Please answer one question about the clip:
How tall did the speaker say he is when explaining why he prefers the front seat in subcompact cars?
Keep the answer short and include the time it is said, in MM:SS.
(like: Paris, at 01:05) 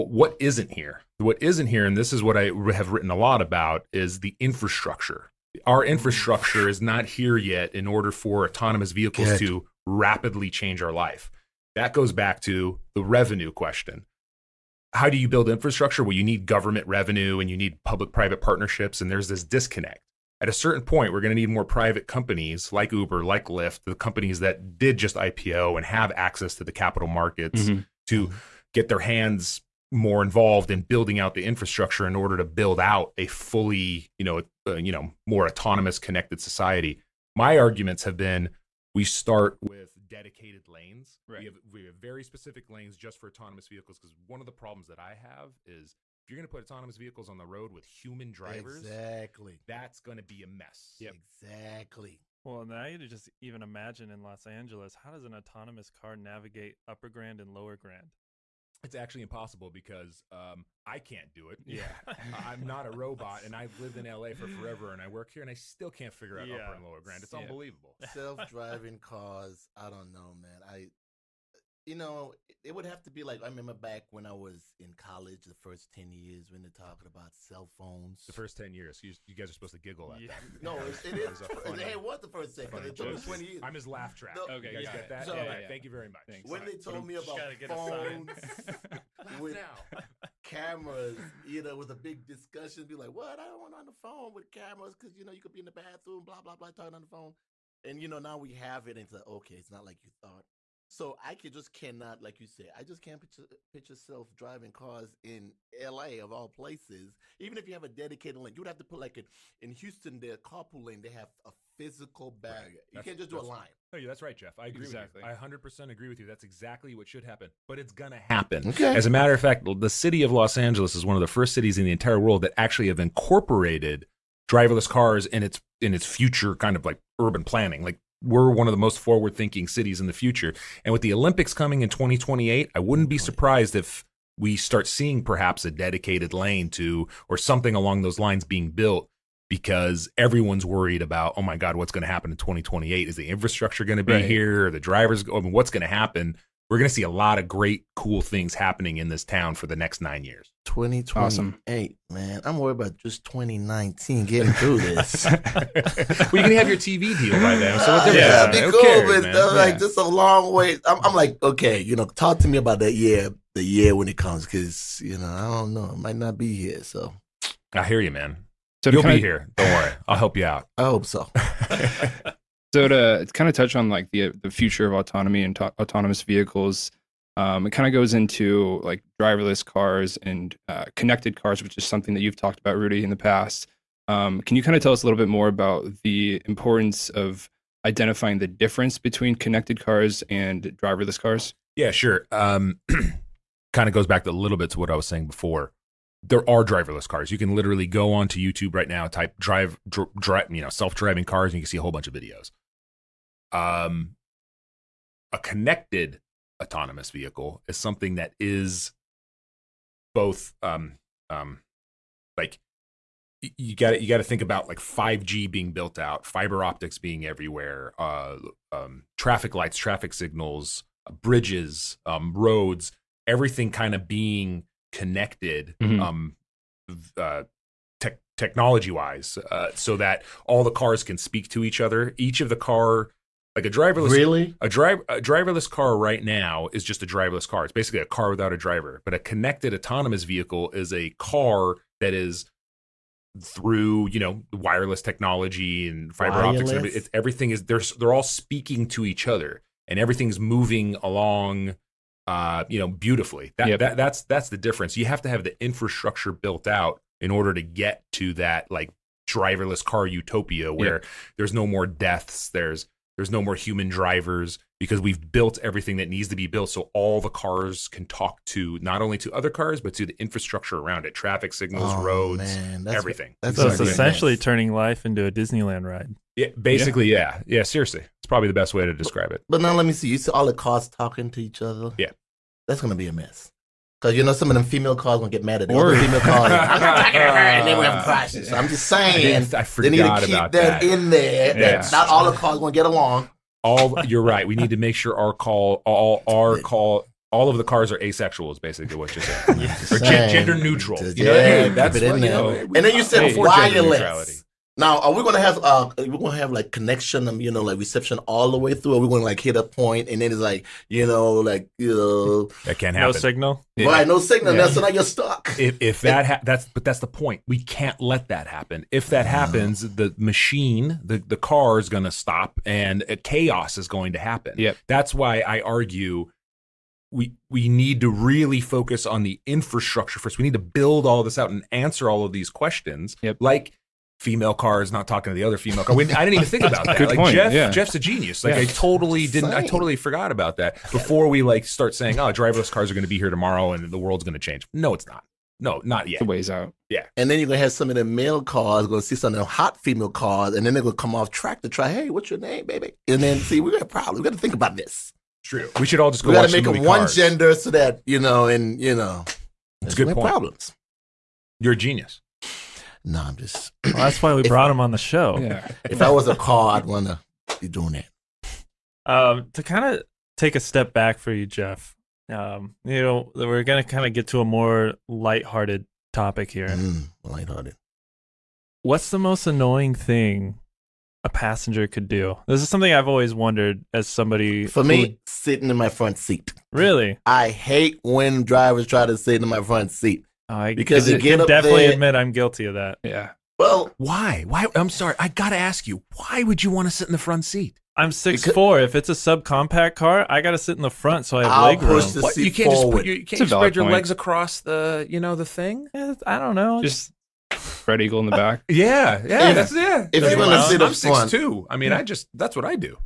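6 foot 4, at 06:38.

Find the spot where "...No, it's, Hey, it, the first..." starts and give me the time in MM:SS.
01:20.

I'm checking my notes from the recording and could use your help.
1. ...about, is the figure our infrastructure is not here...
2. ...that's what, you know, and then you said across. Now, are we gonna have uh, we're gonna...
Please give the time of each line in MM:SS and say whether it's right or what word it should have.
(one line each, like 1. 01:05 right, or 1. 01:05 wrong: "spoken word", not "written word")
1. 00:03 wrong: "infrastructure", not "figure"
2. 05:01 wrong: "wireless", not "across".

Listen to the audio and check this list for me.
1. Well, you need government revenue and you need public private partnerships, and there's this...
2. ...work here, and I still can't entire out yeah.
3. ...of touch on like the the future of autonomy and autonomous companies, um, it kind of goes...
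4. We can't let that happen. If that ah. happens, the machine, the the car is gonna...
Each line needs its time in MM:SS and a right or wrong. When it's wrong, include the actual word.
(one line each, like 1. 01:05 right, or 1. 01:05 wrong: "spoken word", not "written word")
1. 00:16 right
2. 01:05 wrong: "figure", not "entire"
3. 02:53 wrong: "vehicles", not "companies"
4. 05:17 right.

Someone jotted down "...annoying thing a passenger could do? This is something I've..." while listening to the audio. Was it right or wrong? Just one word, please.
right.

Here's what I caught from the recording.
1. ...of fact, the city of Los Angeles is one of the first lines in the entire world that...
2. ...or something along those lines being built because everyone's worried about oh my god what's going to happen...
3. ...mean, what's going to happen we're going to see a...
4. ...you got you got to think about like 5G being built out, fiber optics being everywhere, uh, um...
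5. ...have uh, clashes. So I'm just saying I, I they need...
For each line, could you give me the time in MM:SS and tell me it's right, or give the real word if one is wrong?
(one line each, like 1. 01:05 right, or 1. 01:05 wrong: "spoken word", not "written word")
1. 01:59 wrong: "cities", not "lines"
2. 02:17 right
3. 02:25 right
4. 03:33 right
5. 04:47 right.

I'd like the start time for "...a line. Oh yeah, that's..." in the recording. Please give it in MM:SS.
01:53.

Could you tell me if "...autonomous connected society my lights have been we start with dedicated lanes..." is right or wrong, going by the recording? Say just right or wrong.
wrong.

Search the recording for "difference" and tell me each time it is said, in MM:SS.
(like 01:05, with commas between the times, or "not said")
03:08, 04:14.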